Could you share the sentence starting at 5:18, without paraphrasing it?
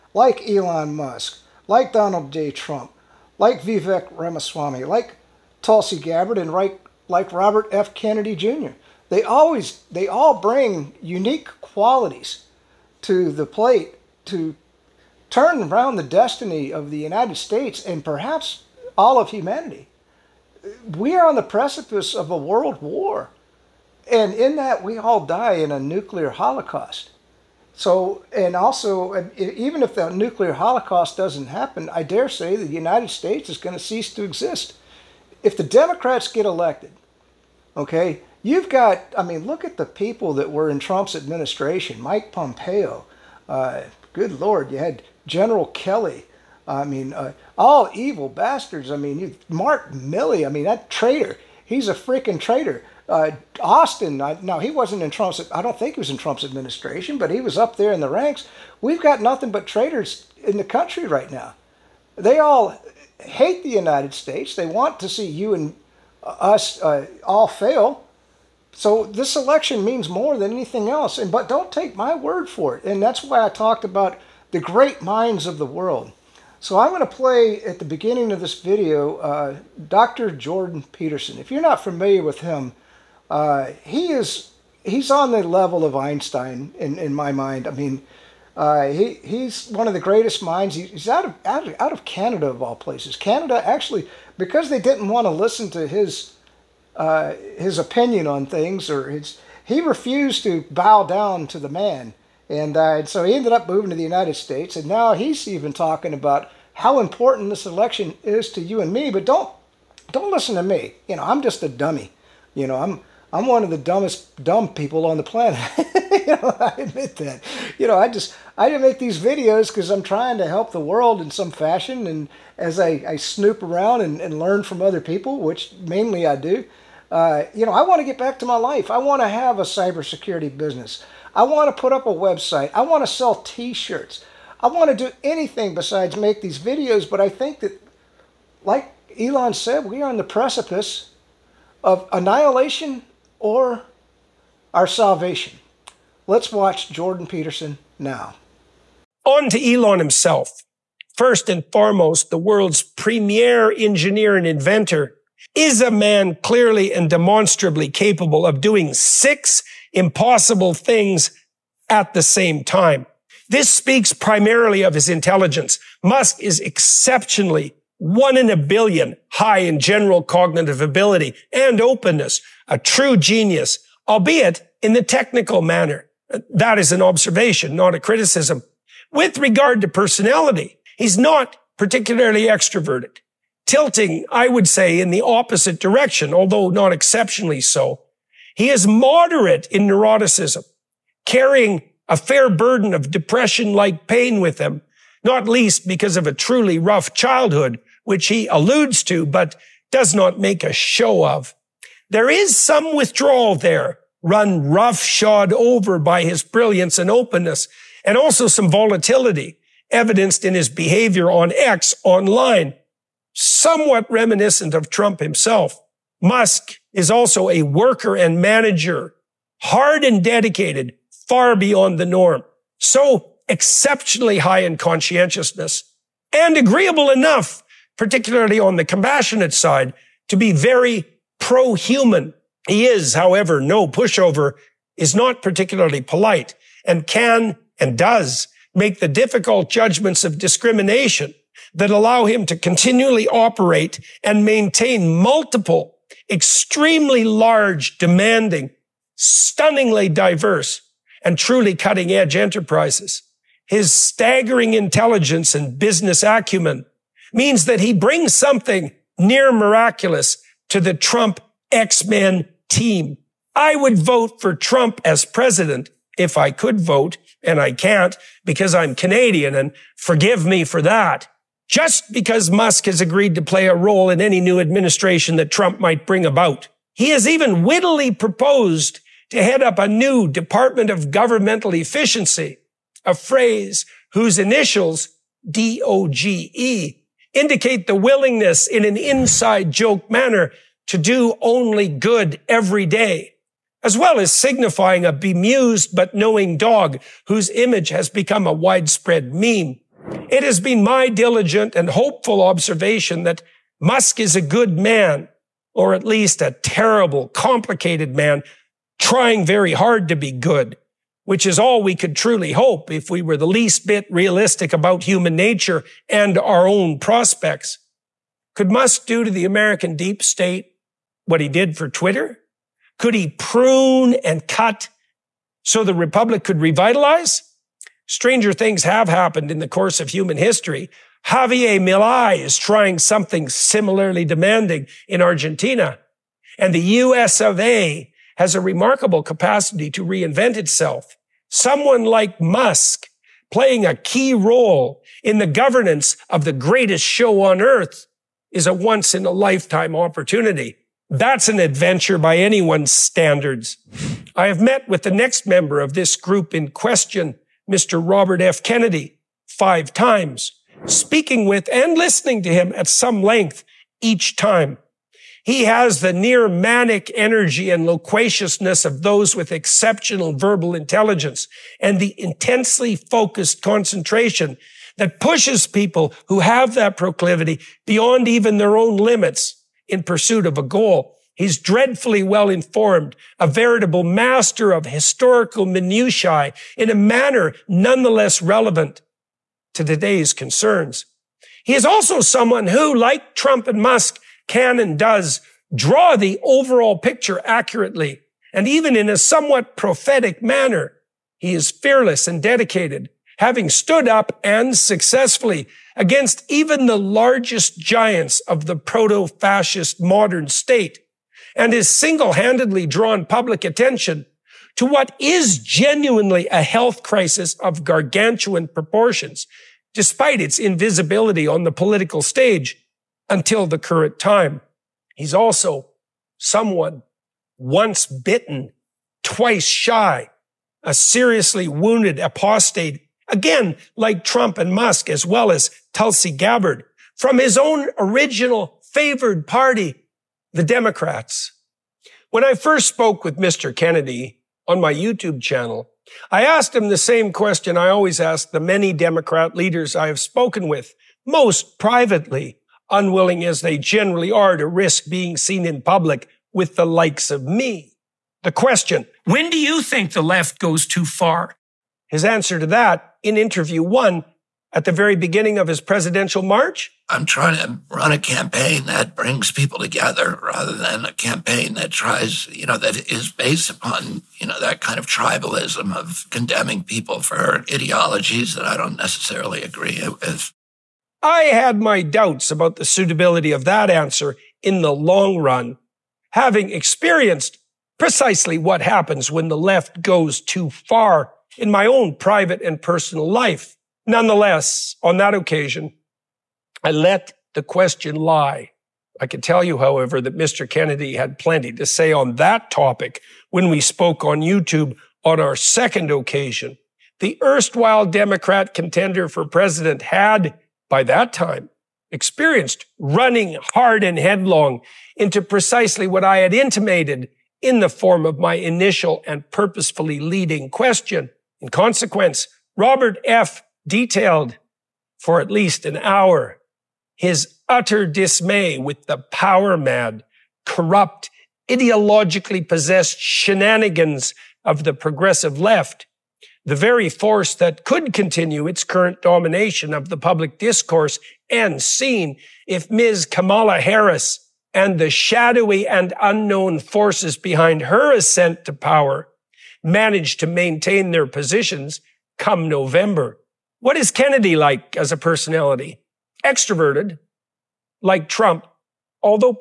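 Could Musk do to the American deep state what he did for Twitter?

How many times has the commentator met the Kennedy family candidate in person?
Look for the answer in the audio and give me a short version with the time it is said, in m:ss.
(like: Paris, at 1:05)
5, at 5:59.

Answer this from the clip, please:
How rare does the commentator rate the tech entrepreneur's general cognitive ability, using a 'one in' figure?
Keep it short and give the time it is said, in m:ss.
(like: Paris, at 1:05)
one in a billion, at 2:47.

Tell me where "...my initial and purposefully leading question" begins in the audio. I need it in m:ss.
8:38.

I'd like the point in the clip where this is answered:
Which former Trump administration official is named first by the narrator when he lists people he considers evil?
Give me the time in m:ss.
0:42.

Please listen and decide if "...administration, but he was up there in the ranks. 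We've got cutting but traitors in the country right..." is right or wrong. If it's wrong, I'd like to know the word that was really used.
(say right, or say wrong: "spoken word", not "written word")
wrong: "nothing", not "cutting".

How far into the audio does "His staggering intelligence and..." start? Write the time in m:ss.
4:13.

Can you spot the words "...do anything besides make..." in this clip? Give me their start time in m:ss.
2:15.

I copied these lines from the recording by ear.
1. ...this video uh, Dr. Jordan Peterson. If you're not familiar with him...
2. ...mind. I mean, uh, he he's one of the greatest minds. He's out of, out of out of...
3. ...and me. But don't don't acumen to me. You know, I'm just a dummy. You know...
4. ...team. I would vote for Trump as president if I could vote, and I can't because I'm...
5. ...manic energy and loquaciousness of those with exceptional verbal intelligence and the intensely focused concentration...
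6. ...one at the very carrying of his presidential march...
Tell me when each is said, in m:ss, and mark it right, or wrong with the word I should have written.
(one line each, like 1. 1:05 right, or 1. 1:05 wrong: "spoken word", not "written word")
1. 1:18 right
2. 1:27 right
3. 1:48 wrong: "listen", not "acumen"
4. 4:22 right
5. 6:06 right
6. 7:43 wrong: "beginning", not "carrying".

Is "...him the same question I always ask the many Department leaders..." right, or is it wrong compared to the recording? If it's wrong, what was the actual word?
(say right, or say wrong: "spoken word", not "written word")
wrong: "Democrat", not "Department".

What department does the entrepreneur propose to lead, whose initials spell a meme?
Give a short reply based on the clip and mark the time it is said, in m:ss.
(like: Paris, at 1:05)
Department of Governmental Efficiency, at 4:40.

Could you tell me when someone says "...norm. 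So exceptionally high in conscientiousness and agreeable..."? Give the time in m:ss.
3:42.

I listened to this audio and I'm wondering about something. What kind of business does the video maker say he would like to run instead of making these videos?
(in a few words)
cybersecurity business.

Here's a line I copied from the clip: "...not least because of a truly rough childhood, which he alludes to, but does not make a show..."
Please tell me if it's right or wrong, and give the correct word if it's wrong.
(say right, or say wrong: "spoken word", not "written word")
right.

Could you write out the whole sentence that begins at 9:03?
Kamala Harris and the shadowy and unknown forces behind her ascent to power manage to maintain their positions come November.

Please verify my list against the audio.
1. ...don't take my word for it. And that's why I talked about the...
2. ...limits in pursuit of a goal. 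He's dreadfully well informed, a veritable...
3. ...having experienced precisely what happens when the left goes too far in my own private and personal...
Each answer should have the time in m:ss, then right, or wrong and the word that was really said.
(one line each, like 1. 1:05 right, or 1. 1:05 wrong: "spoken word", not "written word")
1. 1:11 right
2. 6:18 right
3. 8:06 right.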